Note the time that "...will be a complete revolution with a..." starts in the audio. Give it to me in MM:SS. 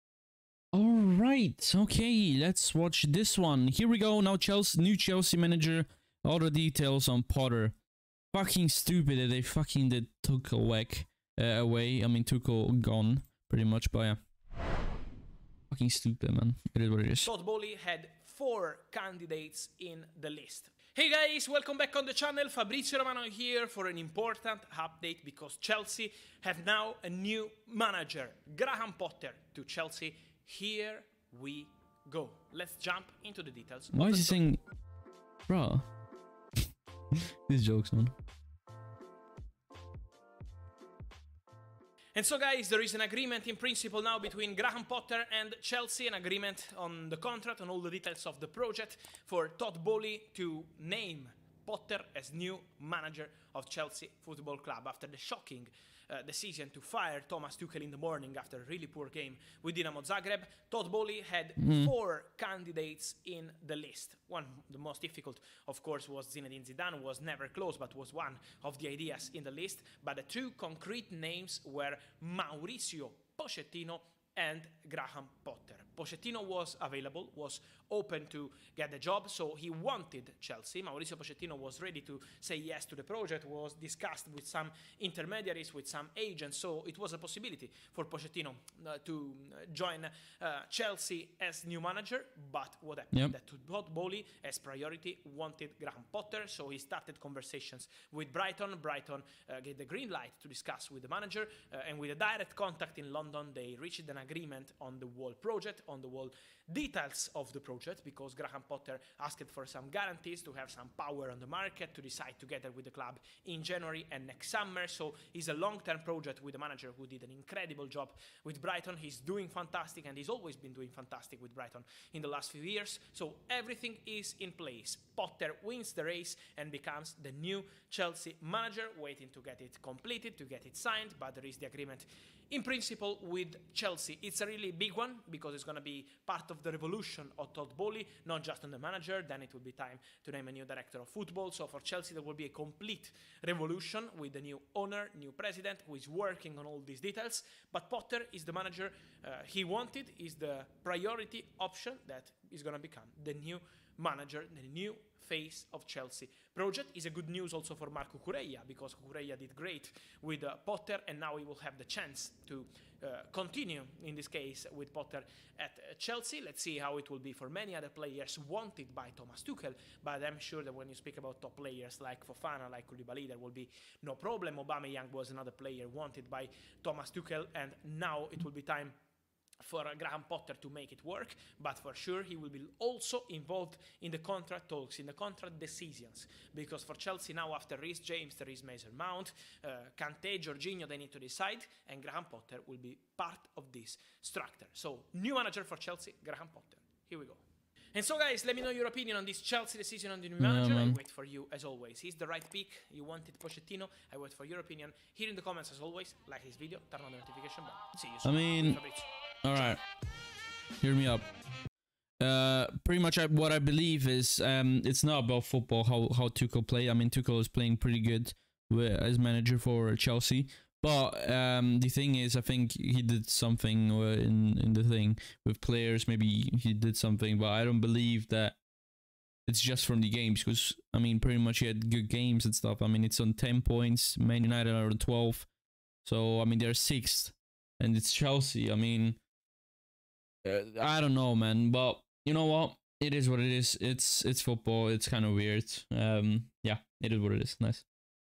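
02:22.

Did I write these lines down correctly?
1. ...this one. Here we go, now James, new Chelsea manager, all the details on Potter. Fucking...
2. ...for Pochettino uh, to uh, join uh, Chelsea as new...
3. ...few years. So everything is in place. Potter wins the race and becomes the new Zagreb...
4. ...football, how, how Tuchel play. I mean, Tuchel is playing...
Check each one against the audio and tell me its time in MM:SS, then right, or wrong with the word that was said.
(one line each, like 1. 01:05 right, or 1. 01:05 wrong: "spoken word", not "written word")
1. 00:03 wrong: "Chelsea", not "James"
2. 01:27 right
3. 02:02 wrong: "Chelsea", not "Zagreb"
4. 03:35 right.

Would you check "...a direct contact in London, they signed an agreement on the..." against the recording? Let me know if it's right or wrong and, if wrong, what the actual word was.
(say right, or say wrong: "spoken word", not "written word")
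wrong: "reached", not "signed".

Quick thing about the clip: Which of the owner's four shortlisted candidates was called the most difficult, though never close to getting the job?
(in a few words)
Zinedine Zidane.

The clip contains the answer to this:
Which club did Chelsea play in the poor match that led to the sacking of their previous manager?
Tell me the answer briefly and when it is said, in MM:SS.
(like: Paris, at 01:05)
Dinamo Zagreb, at 00:59.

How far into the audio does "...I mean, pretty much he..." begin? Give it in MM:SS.
03:50.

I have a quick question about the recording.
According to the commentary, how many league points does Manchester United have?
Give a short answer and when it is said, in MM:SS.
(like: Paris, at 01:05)
12, at 03:54.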